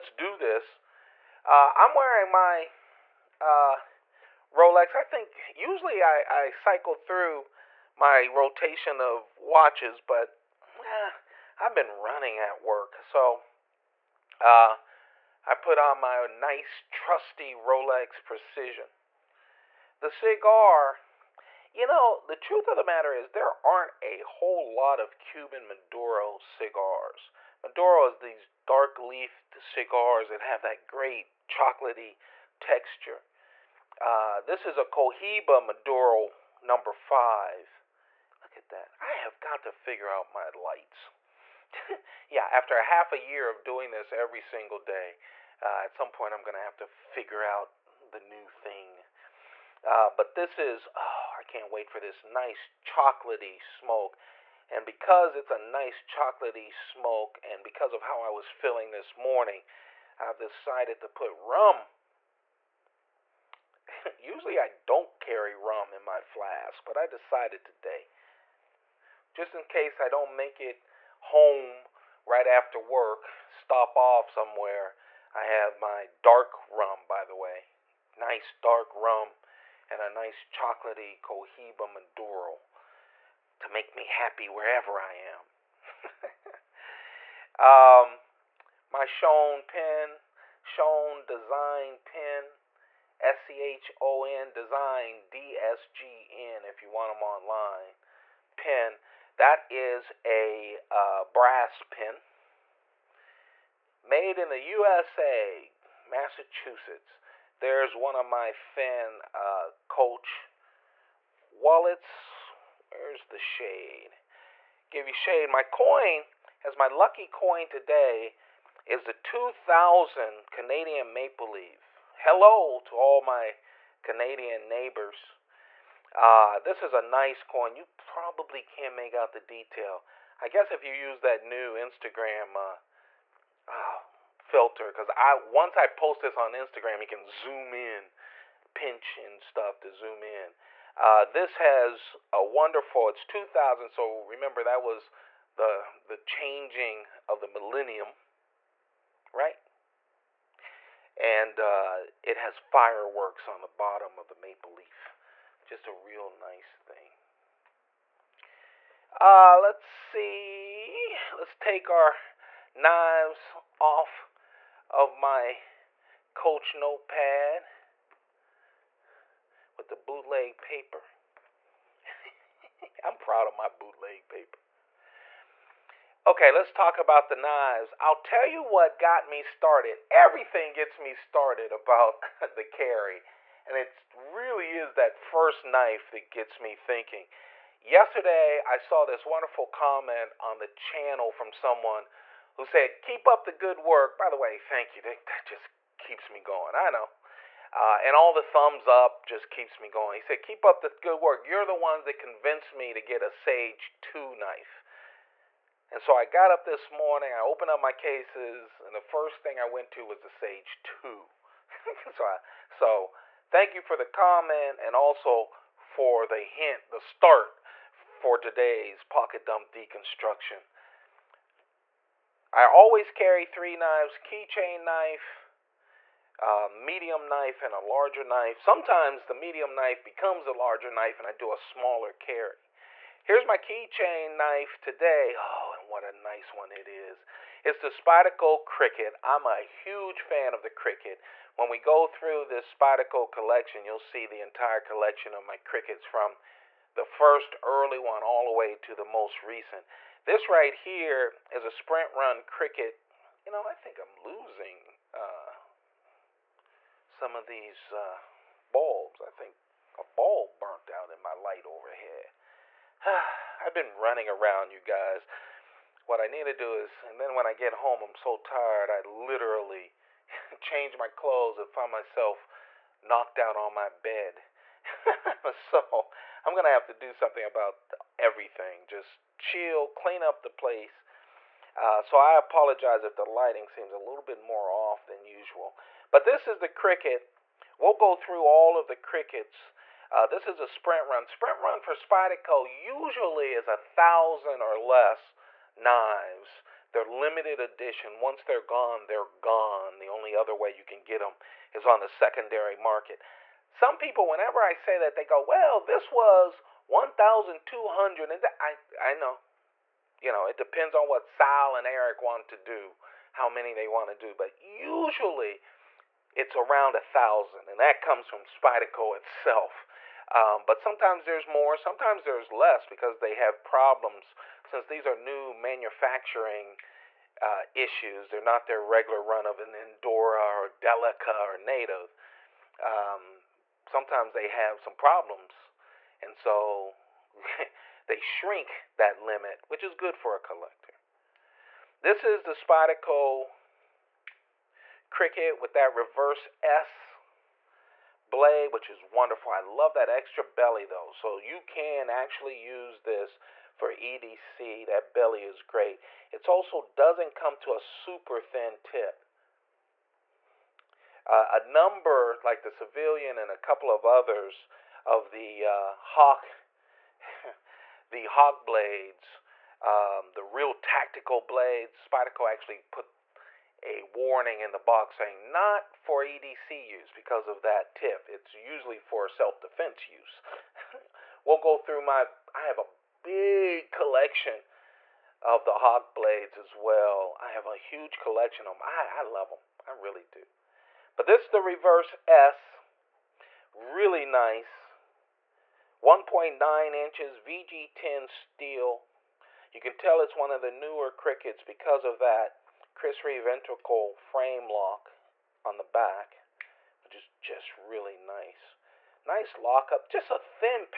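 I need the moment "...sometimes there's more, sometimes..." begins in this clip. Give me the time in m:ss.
5:20.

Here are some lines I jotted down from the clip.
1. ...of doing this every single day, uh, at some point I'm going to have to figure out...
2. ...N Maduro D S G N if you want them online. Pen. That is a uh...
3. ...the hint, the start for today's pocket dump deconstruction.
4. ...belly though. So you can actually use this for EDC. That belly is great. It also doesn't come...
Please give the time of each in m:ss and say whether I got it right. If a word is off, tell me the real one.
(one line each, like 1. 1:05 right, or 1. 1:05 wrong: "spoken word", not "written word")
1. 0:43 right
2. 1:34 wrong: "Design", not "Maduro"
3. 3:36 right
4. 5:50 right.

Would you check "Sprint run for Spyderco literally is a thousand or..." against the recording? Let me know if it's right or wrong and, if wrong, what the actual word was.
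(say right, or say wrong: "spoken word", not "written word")
wrong: "usually", not "literally".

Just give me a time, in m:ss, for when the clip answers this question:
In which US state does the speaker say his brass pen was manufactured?
1:46.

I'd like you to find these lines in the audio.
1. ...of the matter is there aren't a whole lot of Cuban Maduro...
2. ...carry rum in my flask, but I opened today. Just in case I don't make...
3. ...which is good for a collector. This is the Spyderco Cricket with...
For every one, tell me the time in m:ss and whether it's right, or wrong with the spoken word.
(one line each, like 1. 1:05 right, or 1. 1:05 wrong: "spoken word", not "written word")
1. 0:22 right
2. 1:05 wrong: "decided", not "opened"
3. 5:39 right.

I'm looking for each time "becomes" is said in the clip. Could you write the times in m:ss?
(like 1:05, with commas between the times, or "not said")
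3:50.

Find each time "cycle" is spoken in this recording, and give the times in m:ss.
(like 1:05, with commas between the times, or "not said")
0:06.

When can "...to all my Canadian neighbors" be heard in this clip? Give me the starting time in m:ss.
2:02.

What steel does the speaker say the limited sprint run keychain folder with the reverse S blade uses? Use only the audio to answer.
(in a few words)
VG10.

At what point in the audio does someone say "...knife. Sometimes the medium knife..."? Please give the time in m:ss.
3:48.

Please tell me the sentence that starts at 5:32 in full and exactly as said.
Um, sometimes they have some problems.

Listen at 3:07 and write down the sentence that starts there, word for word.
Yesterday, I saw this wonderful comment on the channel from someone who said, Keep up the good work.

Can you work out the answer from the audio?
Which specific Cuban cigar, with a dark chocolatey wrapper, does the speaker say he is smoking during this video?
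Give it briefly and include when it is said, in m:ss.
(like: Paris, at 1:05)
Cohiba Maduro number 5, at 0:34.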